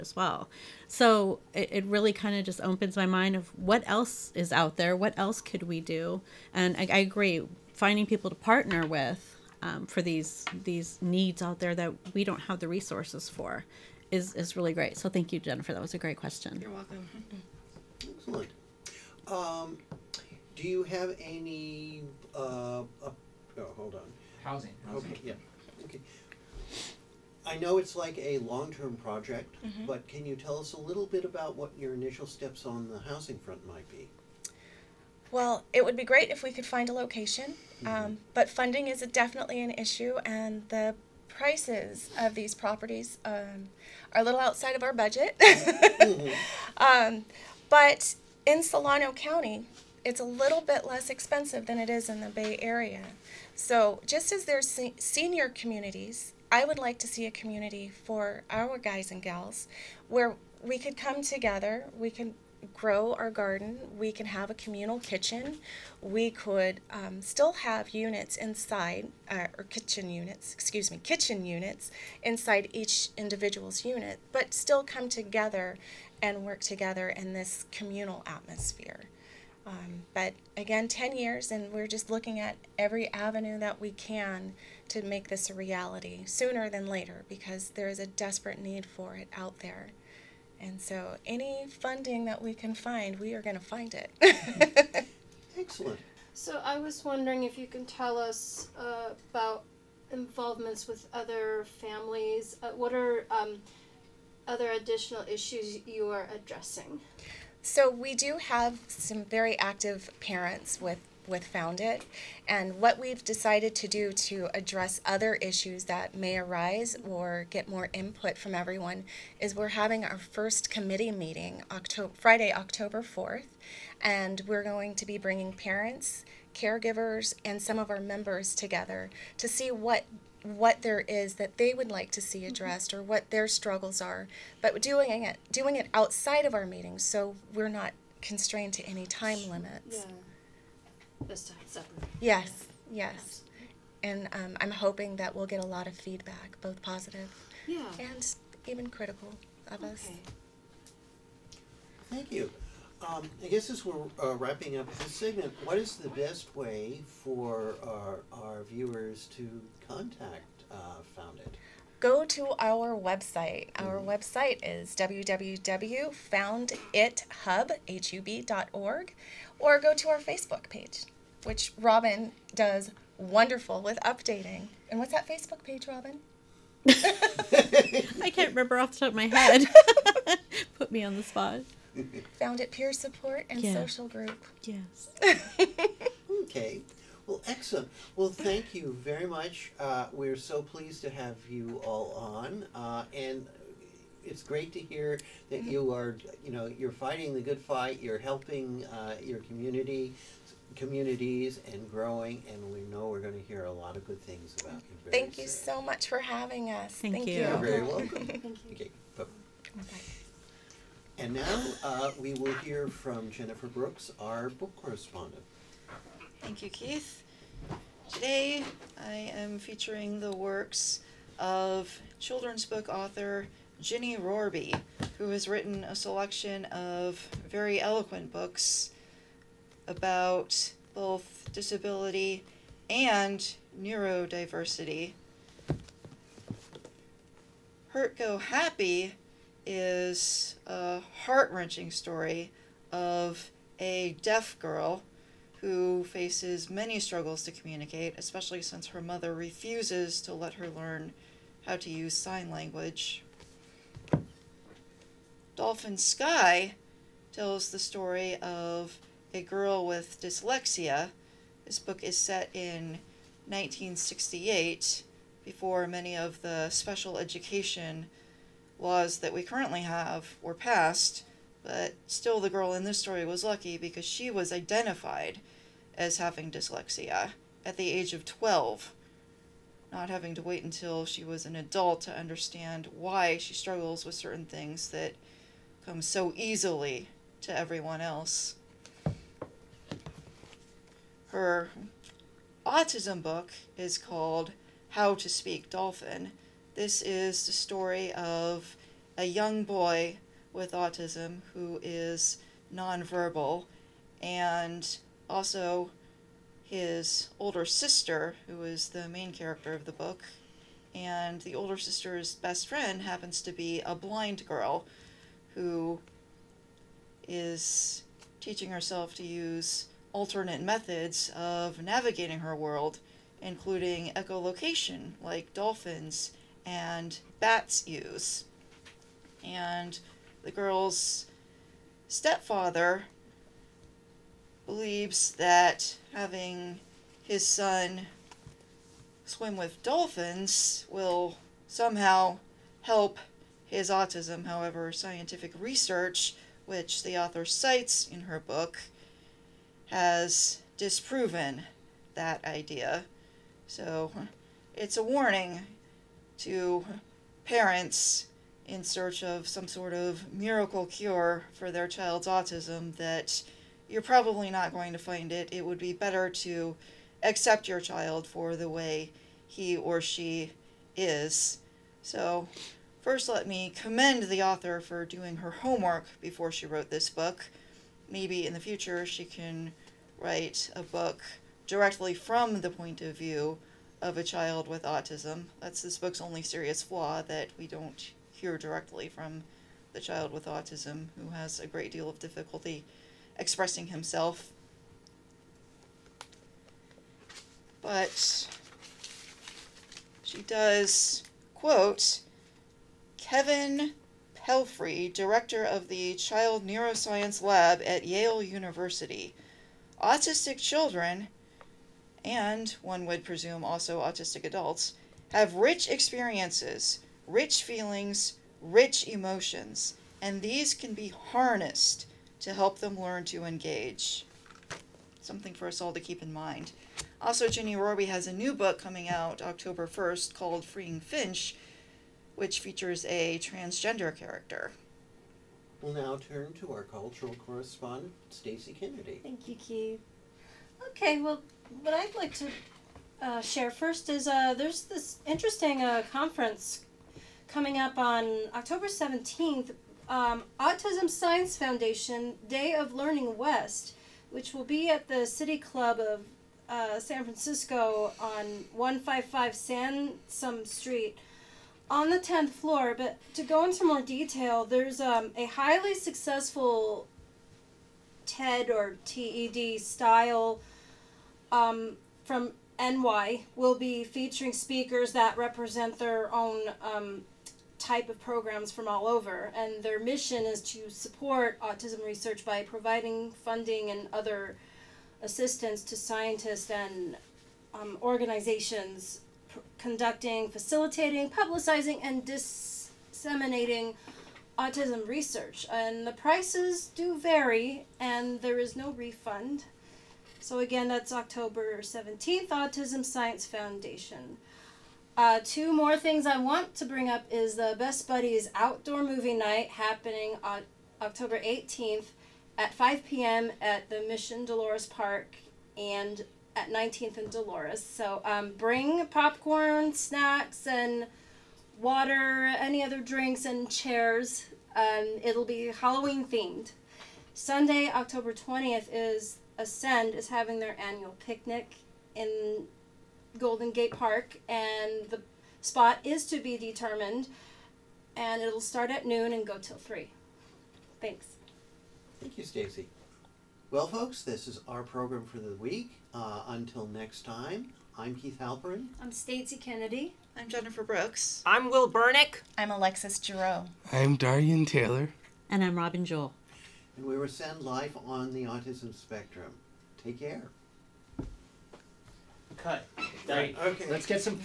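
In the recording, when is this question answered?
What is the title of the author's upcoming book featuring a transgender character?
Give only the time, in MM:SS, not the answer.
07:10.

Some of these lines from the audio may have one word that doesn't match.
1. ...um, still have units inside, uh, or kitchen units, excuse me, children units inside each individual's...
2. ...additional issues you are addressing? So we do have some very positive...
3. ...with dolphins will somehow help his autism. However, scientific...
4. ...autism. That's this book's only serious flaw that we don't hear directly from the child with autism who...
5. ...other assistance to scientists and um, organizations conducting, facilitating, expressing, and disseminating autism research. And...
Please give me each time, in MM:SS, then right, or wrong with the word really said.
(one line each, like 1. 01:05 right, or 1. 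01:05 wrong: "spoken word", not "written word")
1. 01:06 wrong: "kitchen", not "children"
2. 01:44 wrong: "active", not "positive"
3. 05:39 right
4. 06:24 right
5. 08:04 wrong: "publicizing", not "expressing".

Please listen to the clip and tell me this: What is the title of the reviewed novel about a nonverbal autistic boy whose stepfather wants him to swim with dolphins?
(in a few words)
How to Speak Dolphin.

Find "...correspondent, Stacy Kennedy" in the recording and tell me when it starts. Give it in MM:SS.
07:17.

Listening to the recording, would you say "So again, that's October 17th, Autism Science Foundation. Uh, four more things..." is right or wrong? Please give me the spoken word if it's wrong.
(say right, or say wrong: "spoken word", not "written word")
wrong: "two", not "four".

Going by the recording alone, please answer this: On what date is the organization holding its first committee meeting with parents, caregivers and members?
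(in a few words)
Friday, October 4th.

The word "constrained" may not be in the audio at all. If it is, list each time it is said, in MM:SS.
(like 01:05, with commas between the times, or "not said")
02:18.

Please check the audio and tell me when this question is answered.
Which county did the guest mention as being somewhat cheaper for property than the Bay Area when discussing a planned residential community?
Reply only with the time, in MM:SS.
00:48.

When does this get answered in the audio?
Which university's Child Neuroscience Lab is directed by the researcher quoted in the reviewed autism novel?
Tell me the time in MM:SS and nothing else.
06:48.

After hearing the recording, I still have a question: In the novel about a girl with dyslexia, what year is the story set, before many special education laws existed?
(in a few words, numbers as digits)
1968.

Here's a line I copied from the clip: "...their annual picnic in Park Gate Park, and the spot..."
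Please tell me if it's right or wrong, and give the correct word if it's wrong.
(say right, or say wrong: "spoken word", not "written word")
wrong: "Golden", not "Park".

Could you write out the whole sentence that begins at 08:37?
So um, bring popcorn, snacks, and water, any other drinks, and chairs.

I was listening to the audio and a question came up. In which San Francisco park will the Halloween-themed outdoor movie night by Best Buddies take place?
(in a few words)
Mission Dolores Park.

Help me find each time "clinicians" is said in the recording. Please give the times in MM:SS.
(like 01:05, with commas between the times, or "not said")
not said.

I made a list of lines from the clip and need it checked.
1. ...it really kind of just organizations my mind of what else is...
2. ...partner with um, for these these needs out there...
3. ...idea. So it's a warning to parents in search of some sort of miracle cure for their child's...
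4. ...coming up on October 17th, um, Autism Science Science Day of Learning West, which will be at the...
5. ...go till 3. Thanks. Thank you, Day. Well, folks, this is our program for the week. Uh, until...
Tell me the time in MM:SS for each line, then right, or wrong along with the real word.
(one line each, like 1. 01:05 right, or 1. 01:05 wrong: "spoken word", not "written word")
1. 00:01 wrong: "opens", not "organizations"
2. 00:08 right
3. 05:52 right
4. 07:27 wrong: "Foundation", not "Science"
5. 08:59 wrong: "Stacy", not "Day".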